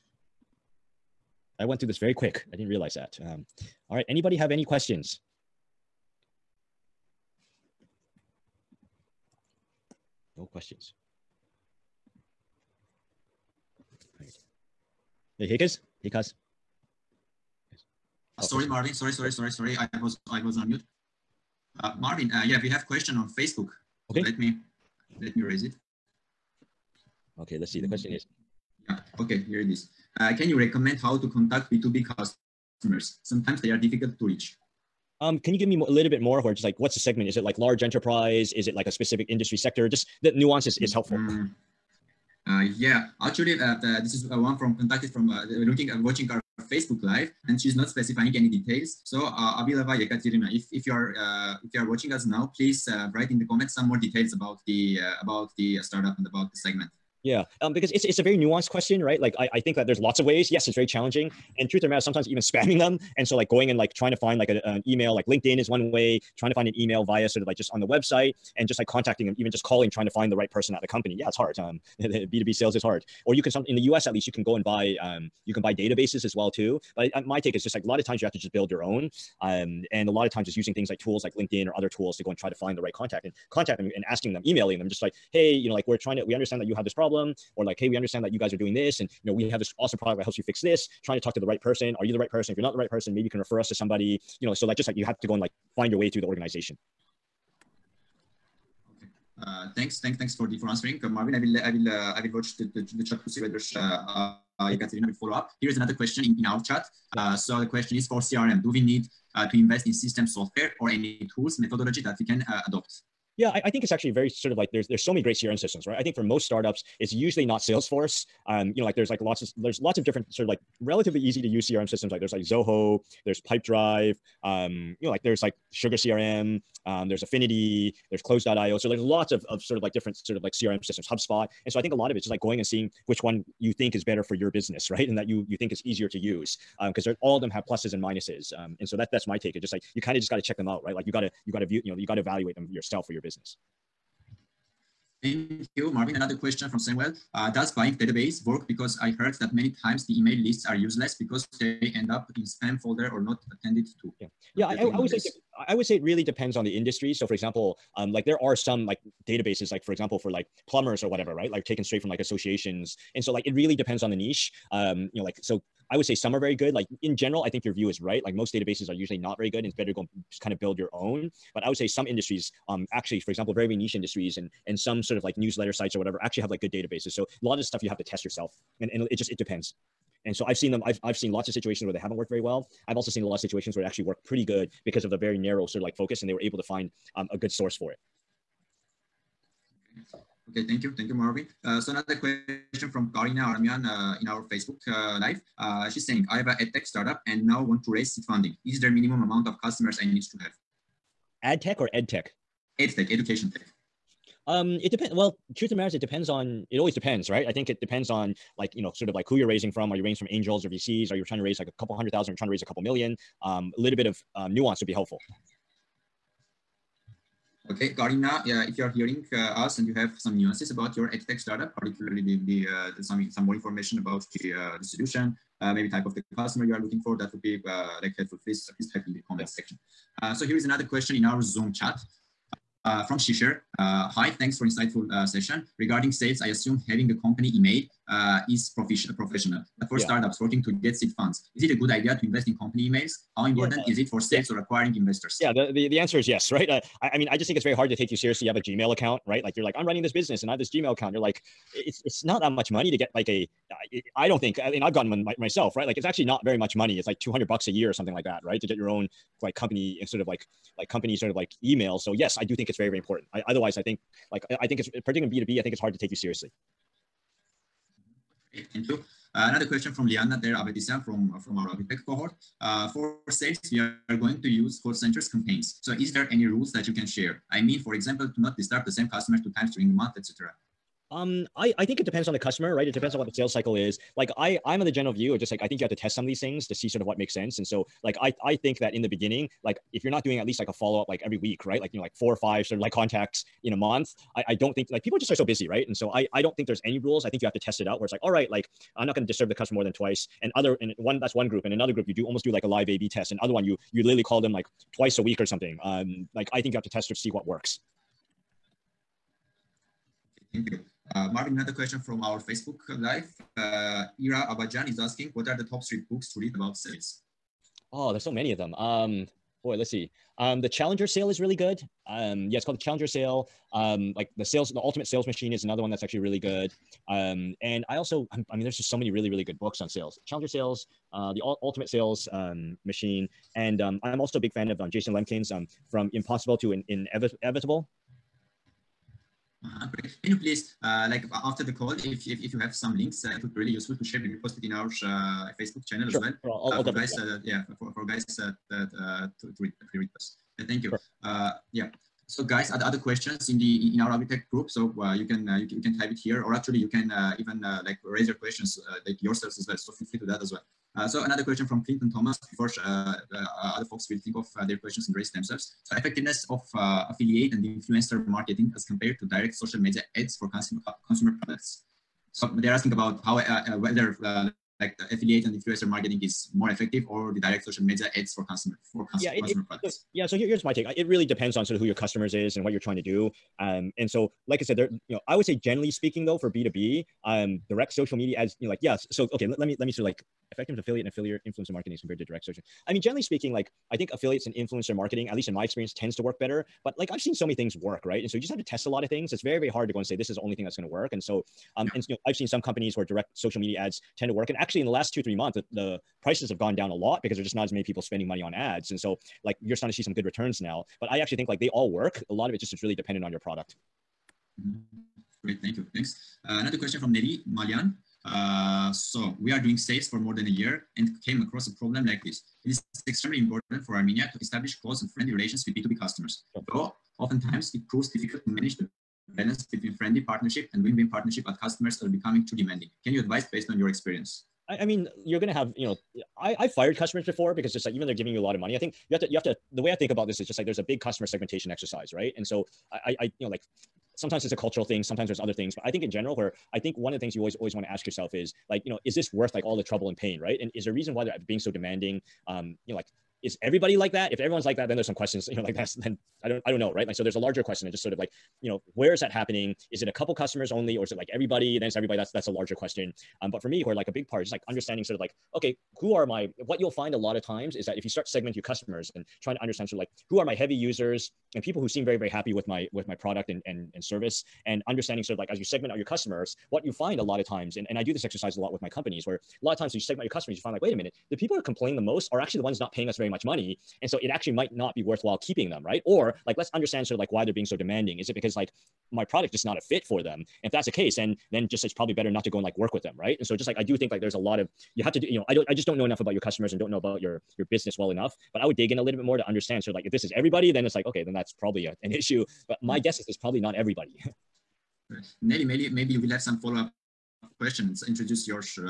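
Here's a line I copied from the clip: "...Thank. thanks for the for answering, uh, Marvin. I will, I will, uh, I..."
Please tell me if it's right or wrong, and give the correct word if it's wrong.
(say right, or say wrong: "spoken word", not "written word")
right.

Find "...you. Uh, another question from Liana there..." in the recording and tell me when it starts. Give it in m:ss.
4:28.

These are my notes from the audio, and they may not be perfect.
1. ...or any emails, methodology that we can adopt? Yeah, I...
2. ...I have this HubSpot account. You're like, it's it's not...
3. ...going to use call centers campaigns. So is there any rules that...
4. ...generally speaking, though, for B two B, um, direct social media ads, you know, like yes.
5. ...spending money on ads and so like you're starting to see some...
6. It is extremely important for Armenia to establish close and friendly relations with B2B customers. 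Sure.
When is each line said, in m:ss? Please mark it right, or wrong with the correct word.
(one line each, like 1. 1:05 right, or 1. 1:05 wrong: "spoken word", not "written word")
1. 1:50 wrong: "tools", not "emails"
2. 4:10 wrong: "Gmail", not "HubSpot"
3. 4:34 right
4. 6:25 right
5. 6:48 right
6. 7:02 right.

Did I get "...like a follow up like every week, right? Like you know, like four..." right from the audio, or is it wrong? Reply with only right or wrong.
right.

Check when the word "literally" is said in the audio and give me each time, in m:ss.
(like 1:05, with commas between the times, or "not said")
5:04.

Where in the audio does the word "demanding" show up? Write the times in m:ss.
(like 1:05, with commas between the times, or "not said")
7:12, 7:31, 8:07.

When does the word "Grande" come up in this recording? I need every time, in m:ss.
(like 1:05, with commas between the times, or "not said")
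not said.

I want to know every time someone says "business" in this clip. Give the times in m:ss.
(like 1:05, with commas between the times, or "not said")
2:14, 2:23, 4:10, 8:17.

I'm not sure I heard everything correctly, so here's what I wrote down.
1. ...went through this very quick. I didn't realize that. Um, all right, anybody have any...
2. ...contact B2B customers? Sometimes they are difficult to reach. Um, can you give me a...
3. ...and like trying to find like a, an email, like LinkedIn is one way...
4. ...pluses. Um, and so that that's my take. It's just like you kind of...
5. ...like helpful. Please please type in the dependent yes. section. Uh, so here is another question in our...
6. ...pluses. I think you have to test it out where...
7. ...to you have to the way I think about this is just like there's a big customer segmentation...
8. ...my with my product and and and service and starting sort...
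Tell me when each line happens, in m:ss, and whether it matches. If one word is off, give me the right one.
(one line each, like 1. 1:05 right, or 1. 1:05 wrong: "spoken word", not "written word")
1. 0:01 right
2. 0:31 right
3. 1:03 right
4. 2:18 wrong: "minuses", not "pluses"
5. 3:48 wrong: "comment", not "dependent"
6. 4:56 wrong: "rules", not "pluses"
7. 7:19 right
8. 7:52 wrong: "understanding", not "starting".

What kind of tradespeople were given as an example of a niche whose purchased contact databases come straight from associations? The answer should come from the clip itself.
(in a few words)
Plumbers.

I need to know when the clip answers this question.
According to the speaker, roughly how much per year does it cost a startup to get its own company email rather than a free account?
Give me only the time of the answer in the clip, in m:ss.
4:17.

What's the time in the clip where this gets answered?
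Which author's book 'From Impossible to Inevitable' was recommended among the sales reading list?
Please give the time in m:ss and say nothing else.
5:34.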